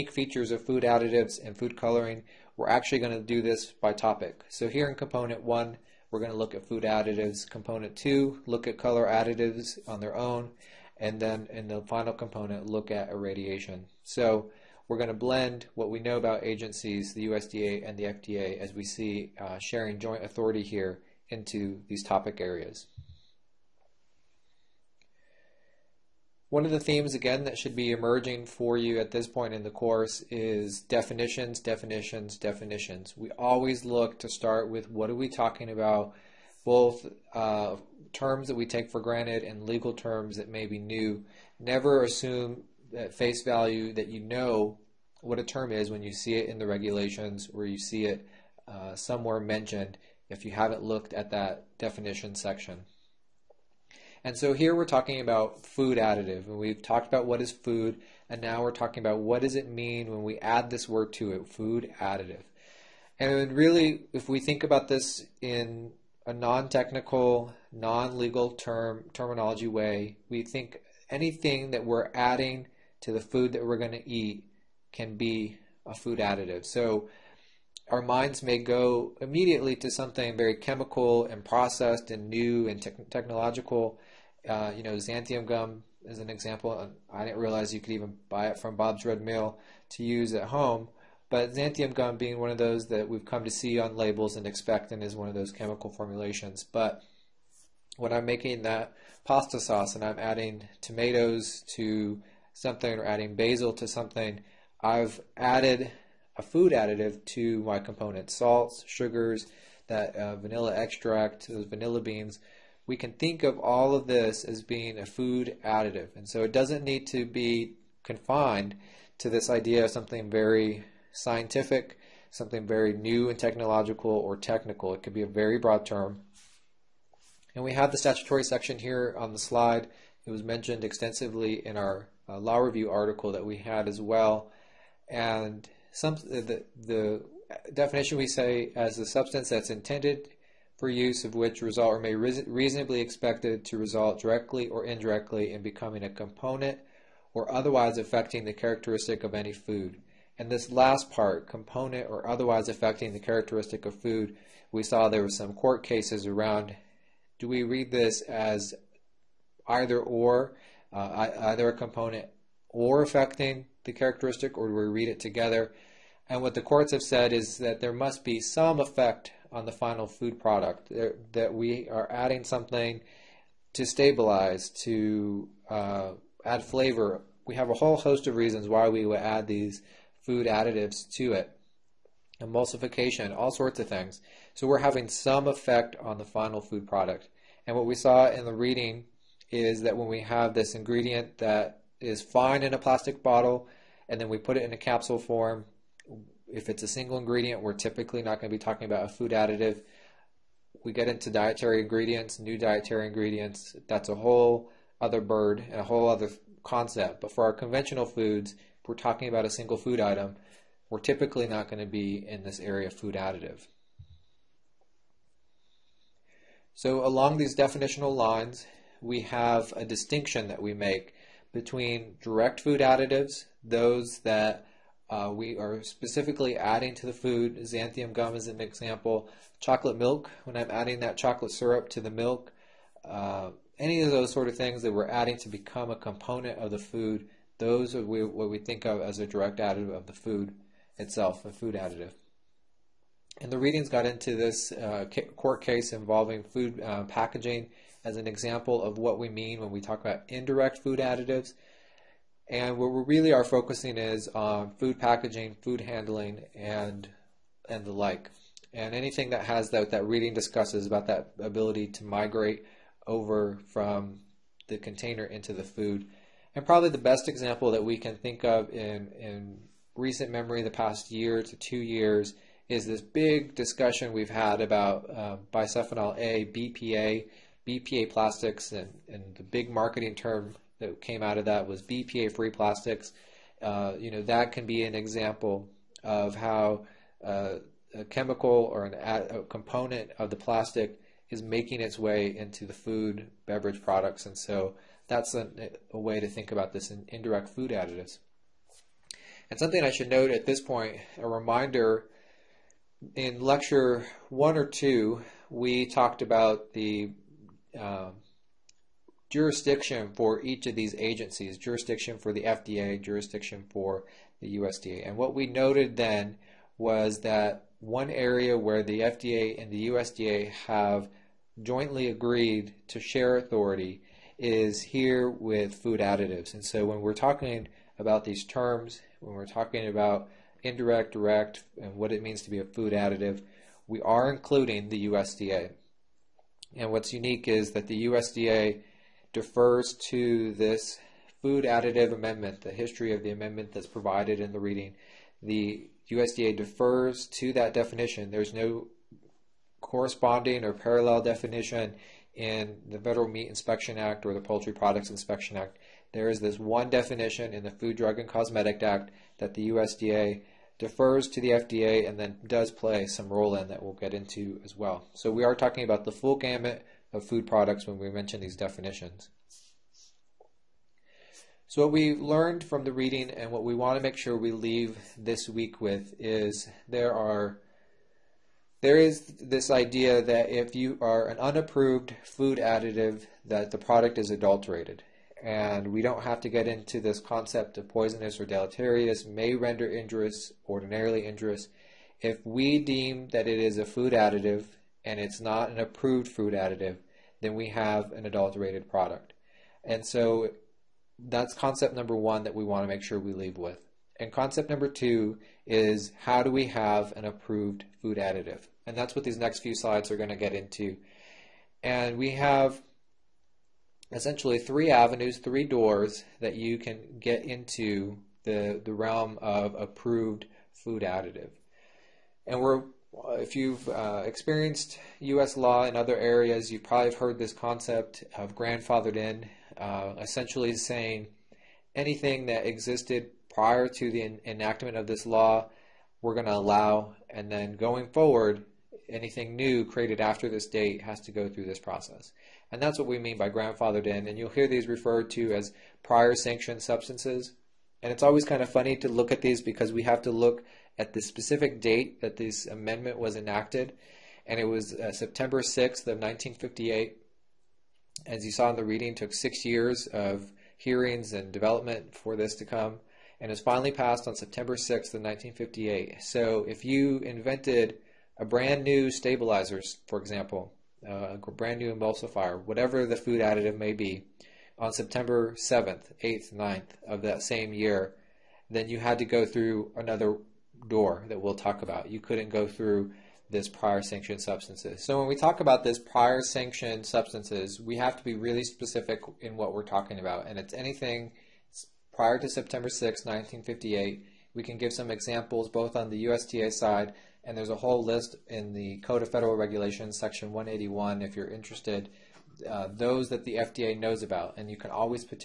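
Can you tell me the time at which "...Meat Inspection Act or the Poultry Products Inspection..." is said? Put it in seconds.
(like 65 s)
353 s.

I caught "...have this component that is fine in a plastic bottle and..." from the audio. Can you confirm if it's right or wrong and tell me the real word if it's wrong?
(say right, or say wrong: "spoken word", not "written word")
wrong: "ingredient", not "component".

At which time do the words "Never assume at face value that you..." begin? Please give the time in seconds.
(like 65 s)
41 s.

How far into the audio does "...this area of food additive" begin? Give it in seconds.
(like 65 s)
212 s.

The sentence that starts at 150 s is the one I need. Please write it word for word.
And this last part, component or otherwise affecting the characteristic of food, we saw there were some court cases around.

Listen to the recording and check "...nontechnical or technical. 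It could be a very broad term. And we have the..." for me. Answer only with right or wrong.
wrong.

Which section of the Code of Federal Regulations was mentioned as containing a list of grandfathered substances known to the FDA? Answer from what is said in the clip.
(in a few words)
Section 181.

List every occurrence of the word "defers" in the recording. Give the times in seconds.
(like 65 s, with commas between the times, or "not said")
339 s, 346 s, 360 s.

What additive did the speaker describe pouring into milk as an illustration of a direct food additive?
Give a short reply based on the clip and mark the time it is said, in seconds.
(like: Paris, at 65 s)
chocolate syrup, at 231 s.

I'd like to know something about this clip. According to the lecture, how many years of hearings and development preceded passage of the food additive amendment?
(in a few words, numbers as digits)
6.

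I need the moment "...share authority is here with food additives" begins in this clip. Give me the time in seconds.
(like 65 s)
323 s.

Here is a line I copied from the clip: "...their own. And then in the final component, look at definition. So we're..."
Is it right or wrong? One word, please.
wrong.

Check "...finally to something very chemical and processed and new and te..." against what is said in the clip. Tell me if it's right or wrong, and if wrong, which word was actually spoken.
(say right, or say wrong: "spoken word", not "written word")
wrong: "immediately", not "finally".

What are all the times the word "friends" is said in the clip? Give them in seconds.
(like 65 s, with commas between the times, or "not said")
not said.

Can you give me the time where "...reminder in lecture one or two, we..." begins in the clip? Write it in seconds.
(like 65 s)
301 s.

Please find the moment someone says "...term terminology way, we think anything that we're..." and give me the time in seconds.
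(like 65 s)
68 s.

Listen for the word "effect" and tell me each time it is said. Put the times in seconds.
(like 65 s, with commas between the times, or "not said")
168 s, 185 s.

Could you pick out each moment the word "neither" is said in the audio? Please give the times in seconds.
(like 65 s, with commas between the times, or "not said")
not said.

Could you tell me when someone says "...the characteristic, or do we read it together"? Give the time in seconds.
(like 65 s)
163 s.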